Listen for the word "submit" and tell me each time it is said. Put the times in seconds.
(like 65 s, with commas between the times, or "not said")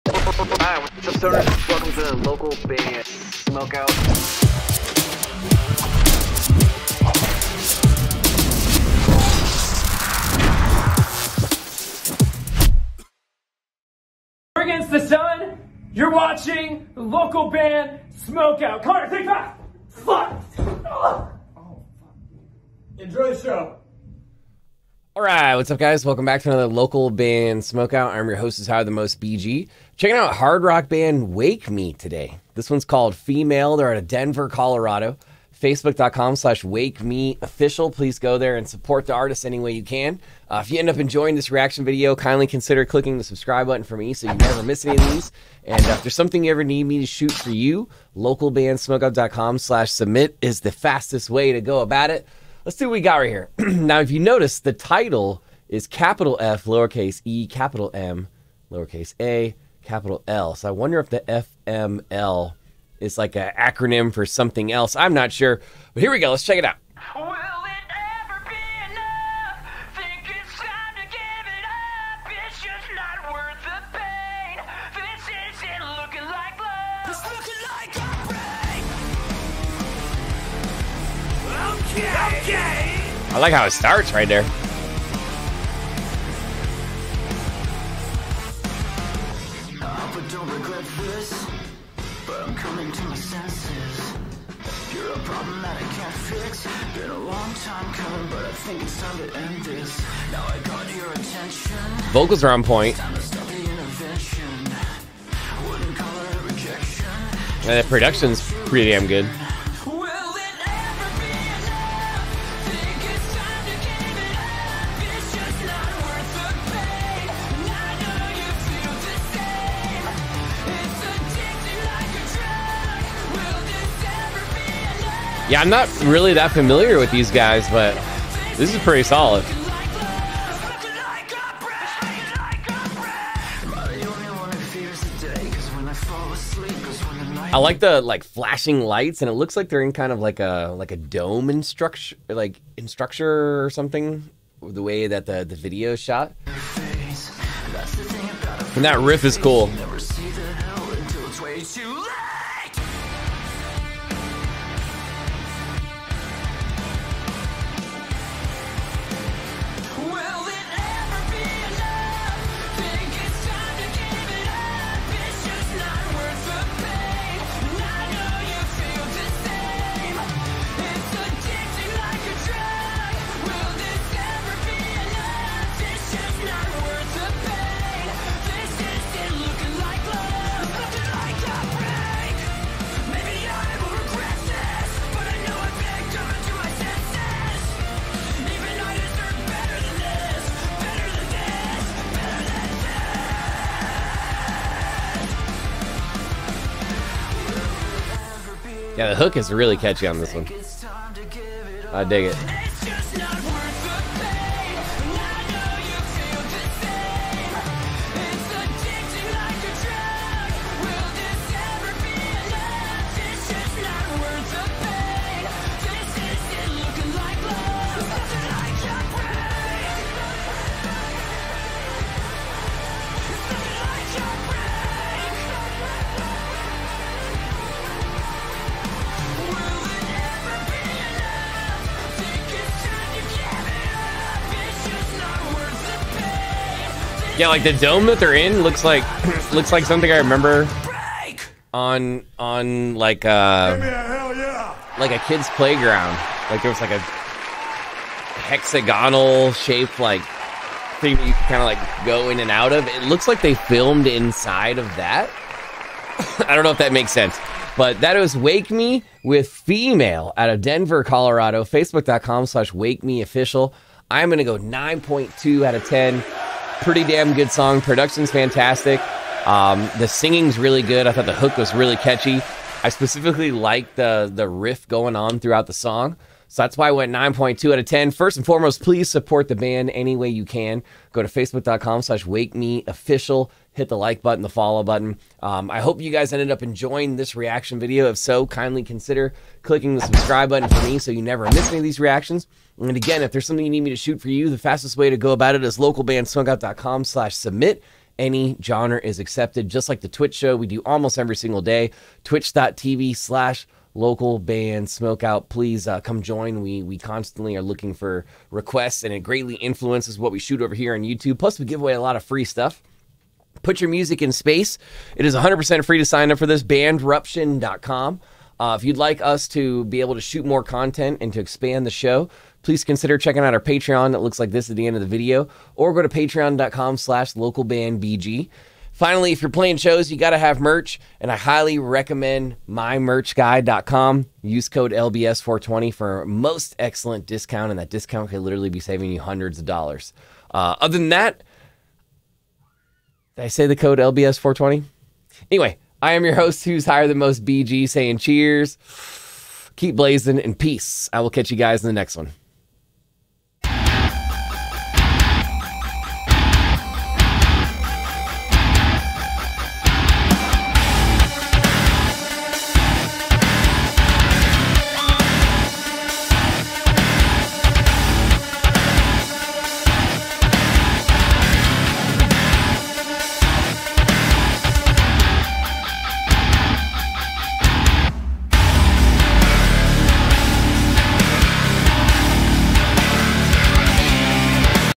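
49 s, 297 s.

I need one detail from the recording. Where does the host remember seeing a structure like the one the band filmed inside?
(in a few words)
A kid's playground.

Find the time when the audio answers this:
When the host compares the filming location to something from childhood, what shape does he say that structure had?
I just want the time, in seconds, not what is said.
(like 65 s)
248 s.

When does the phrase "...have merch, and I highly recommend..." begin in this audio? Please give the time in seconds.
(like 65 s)
330 s.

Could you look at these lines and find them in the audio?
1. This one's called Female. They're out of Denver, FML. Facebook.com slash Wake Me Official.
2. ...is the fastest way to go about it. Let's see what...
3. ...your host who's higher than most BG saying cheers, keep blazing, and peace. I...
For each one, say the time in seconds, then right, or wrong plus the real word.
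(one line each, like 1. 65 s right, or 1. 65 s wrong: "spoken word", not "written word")
1. 32 s wrong: "Colorado", not "FML"
2. 50 s right
3. 346 s right.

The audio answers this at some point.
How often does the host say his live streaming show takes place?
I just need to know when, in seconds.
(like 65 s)
300 s.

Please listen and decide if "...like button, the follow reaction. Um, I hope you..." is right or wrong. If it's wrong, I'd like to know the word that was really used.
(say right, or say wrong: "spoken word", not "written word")
wrong: "button", not "reaction".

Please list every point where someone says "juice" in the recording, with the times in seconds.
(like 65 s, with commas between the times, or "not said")
not said.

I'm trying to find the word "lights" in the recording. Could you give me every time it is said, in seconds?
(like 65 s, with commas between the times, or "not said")
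138 s.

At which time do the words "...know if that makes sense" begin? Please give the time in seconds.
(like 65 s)
256 s.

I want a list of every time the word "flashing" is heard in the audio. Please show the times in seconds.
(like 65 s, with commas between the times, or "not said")
138 s.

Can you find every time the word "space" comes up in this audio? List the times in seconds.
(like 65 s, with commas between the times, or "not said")
314 s.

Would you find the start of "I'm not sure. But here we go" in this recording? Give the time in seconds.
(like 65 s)
64 s.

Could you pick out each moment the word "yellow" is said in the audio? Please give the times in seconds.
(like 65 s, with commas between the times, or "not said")
not said.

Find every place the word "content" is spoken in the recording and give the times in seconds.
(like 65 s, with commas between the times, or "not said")
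320 s.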